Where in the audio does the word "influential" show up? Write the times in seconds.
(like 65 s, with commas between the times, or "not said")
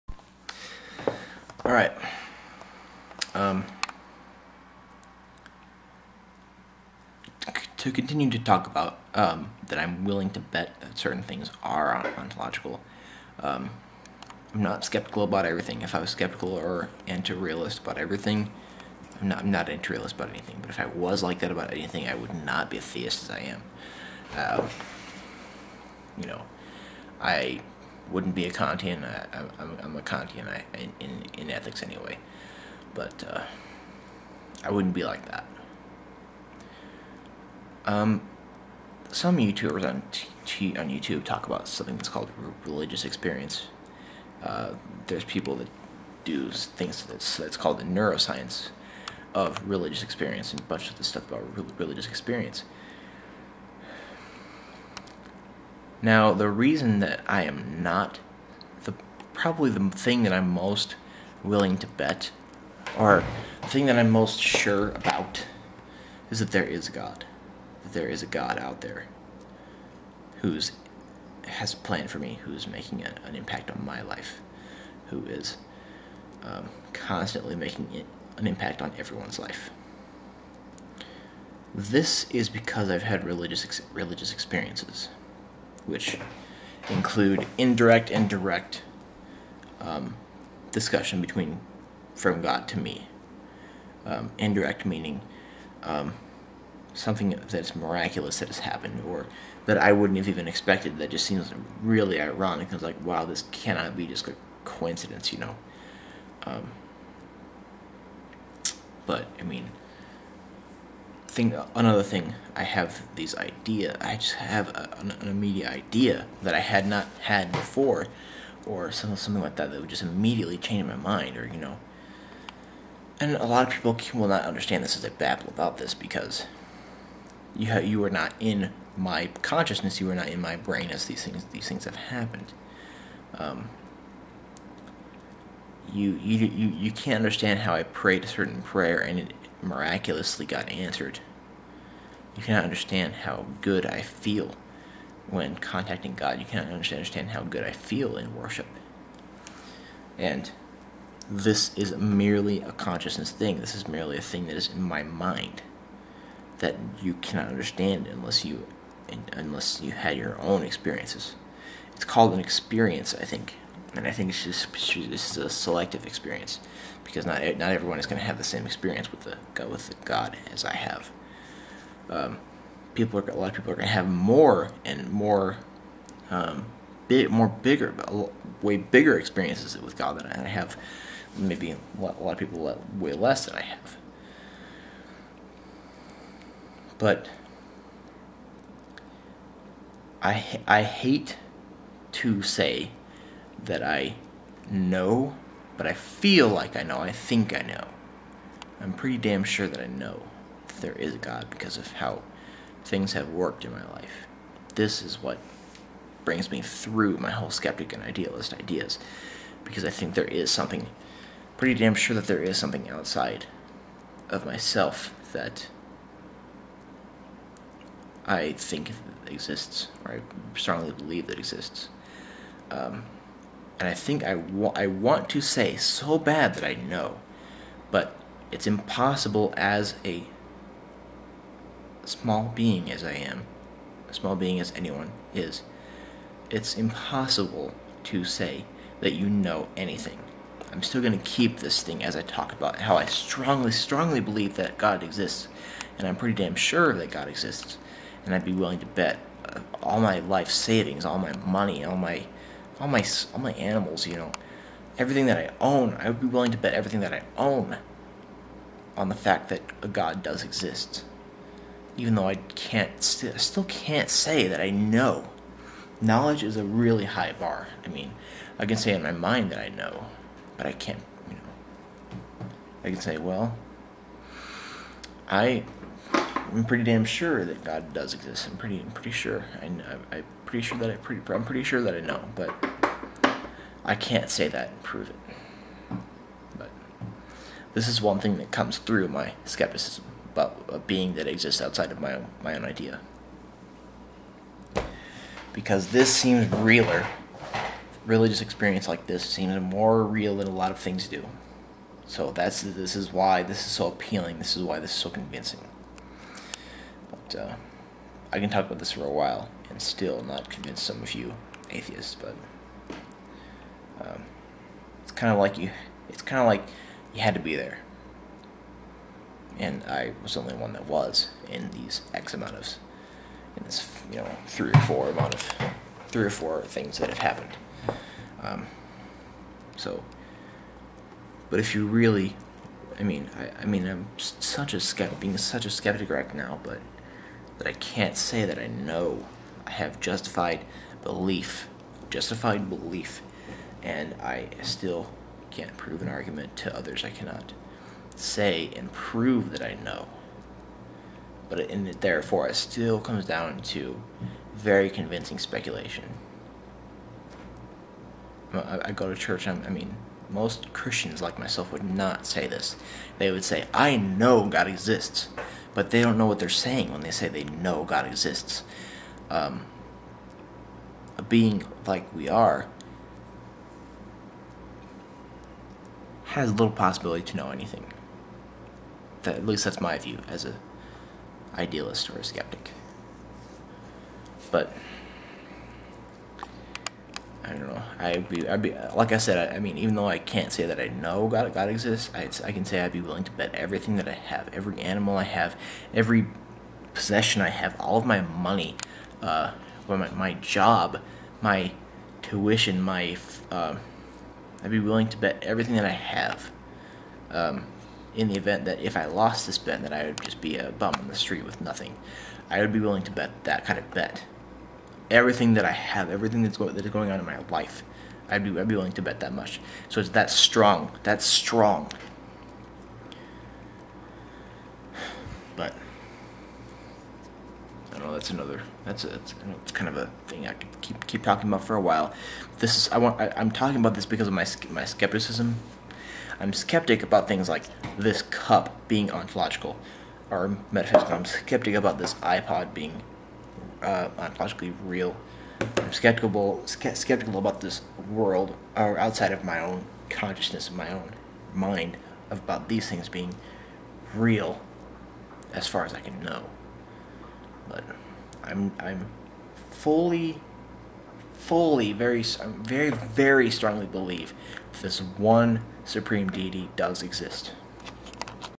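not said.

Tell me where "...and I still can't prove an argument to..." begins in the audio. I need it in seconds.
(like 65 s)
343 s.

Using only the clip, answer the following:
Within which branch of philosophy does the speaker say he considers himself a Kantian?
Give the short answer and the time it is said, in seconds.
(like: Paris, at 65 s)
ethics, at 31 s.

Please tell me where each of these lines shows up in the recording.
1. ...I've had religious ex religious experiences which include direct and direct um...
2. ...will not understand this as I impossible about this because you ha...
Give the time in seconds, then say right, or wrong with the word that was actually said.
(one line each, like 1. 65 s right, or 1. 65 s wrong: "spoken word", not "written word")
1. 82 s wrong: "indirect", not "direct"
2. 124 s wrong: "babble", not "impossible".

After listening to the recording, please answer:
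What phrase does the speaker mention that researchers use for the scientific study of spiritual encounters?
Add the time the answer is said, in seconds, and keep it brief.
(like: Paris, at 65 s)
neuroscience of religious experience, at 47 s.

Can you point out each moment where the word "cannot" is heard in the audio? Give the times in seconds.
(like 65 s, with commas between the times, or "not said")
103 s, 142 s, 146 s, 157 s, 347 s.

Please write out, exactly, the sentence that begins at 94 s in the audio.
Um, indirect meaning um, something that's miraculous that has happened or that I wouldn't have even expected.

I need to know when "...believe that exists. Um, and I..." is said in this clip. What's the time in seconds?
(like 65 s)
220 s.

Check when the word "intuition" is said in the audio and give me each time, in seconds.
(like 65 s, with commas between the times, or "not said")
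not said.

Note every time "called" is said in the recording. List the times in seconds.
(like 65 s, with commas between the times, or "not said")
42 s, 47 s, 162 s.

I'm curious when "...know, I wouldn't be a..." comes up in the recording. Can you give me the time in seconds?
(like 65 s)
26 s.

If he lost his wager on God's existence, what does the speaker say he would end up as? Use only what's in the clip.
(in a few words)
a bum on the street.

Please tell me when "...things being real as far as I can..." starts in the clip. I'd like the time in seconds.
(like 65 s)
452 s.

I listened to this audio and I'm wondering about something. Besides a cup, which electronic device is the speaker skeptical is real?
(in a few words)
iPod.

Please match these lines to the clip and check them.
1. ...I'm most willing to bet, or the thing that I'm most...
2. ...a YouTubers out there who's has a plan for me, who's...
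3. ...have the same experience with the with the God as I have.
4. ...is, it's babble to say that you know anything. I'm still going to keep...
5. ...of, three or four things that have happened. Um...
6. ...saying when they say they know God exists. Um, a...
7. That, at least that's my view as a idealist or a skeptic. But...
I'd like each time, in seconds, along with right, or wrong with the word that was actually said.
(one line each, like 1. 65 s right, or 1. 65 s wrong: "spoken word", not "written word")
1. 60 s right
2. 68 s wrong: "God", not "YouTubers"
3. 168 s right
4. 235 s wrong: "impossible", not "babble"
5. 325 s right
6. 366 s right
7. 379 s right.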